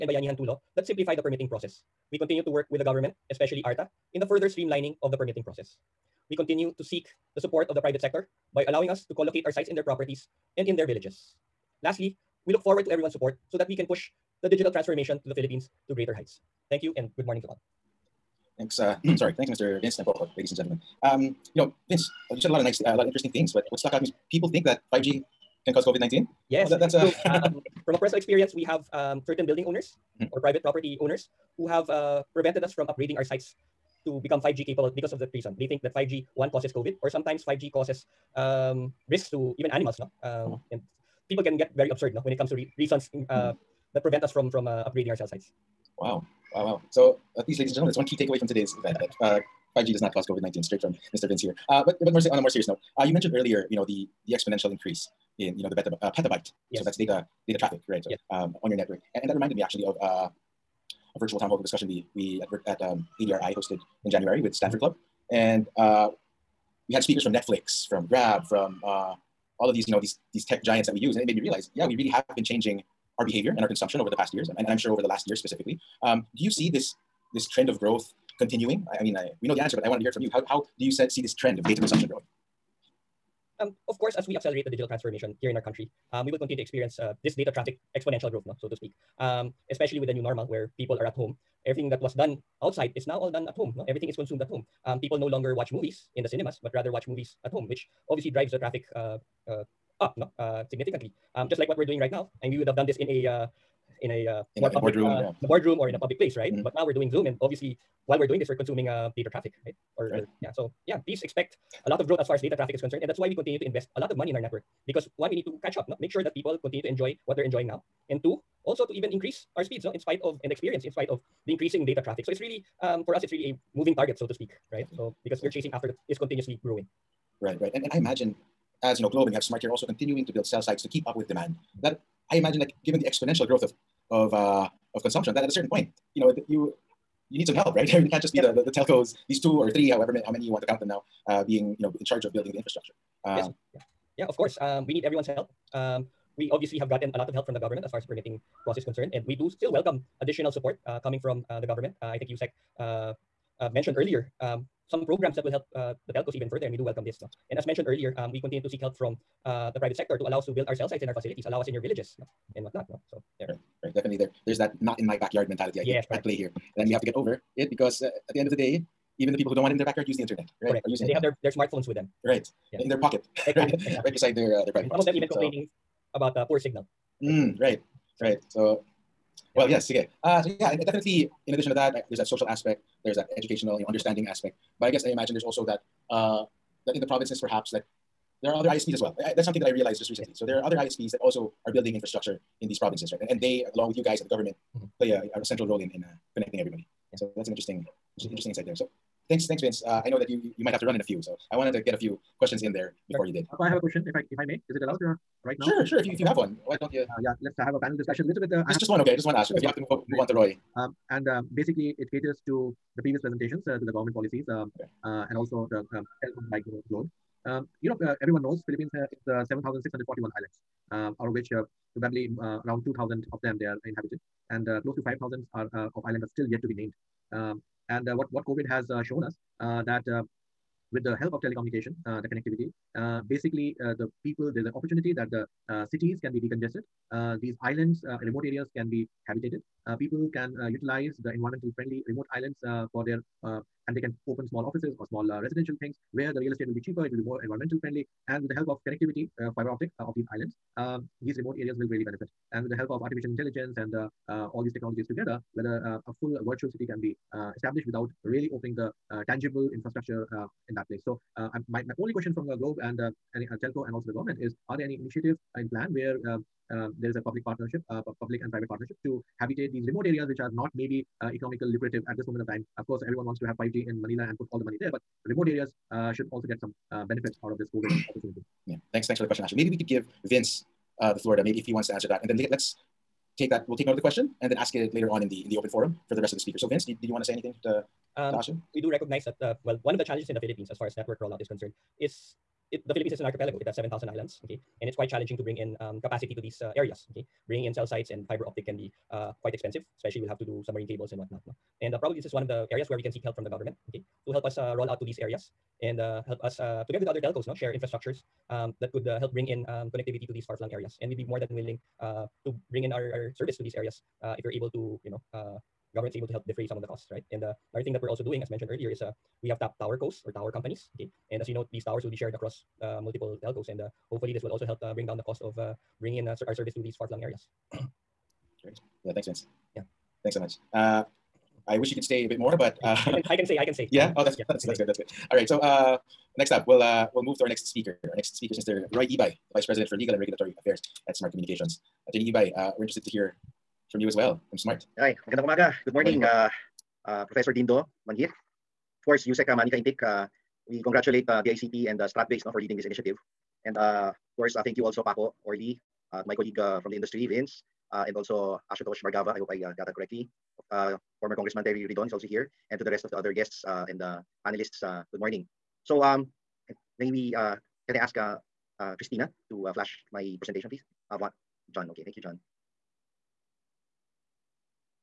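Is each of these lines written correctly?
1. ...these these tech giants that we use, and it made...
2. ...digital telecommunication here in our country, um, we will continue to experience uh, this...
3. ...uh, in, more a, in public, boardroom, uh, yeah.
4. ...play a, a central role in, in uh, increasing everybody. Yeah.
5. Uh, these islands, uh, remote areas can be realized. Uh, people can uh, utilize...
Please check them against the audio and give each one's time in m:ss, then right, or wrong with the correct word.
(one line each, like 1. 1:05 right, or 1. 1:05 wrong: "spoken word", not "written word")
1. 1:09 right
2. 1:24 wrong: "transformation", not "telecommunication"
3. 1:44 right
4. 3:14 wrong: "connecting", not "increasing"
5. 3:57 wrong: "habitated", not "realized".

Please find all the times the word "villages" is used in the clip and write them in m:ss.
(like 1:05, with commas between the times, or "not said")
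0:10, 2:41.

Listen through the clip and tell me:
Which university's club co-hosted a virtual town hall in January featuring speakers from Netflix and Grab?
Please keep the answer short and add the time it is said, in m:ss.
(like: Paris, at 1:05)
Stanford, at 1:04.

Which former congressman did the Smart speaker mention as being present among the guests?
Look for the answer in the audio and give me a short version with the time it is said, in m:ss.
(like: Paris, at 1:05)
Terry Ridon, at 6:01.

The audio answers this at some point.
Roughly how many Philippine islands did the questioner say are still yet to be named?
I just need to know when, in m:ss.
3:45.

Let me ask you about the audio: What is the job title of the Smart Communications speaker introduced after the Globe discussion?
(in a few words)
Vice President for Legal and Regulatory Affairs.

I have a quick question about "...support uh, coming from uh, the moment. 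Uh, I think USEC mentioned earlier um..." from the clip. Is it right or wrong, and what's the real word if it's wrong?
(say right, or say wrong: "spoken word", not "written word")
wrong: "government", not "moment".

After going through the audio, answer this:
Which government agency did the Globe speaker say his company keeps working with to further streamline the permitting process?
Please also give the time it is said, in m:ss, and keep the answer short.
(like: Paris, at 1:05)
ARTA, at 0:03.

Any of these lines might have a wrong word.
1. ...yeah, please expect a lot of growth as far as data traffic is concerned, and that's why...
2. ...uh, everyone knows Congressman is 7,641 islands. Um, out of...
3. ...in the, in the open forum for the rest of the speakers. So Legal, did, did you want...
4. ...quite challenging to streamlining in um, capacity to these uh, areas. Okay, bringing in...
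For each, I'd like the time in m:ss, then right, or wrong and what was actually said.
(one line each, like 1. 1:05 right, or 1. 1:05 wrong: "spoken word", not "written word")
1. 1:50 right
2. 3:38 wrong: "Philippines", not "Congressman"
3. 4:45 wrong: "Vince", not "Legal"
4. 4:54 wrong: "bring", not "streamlining".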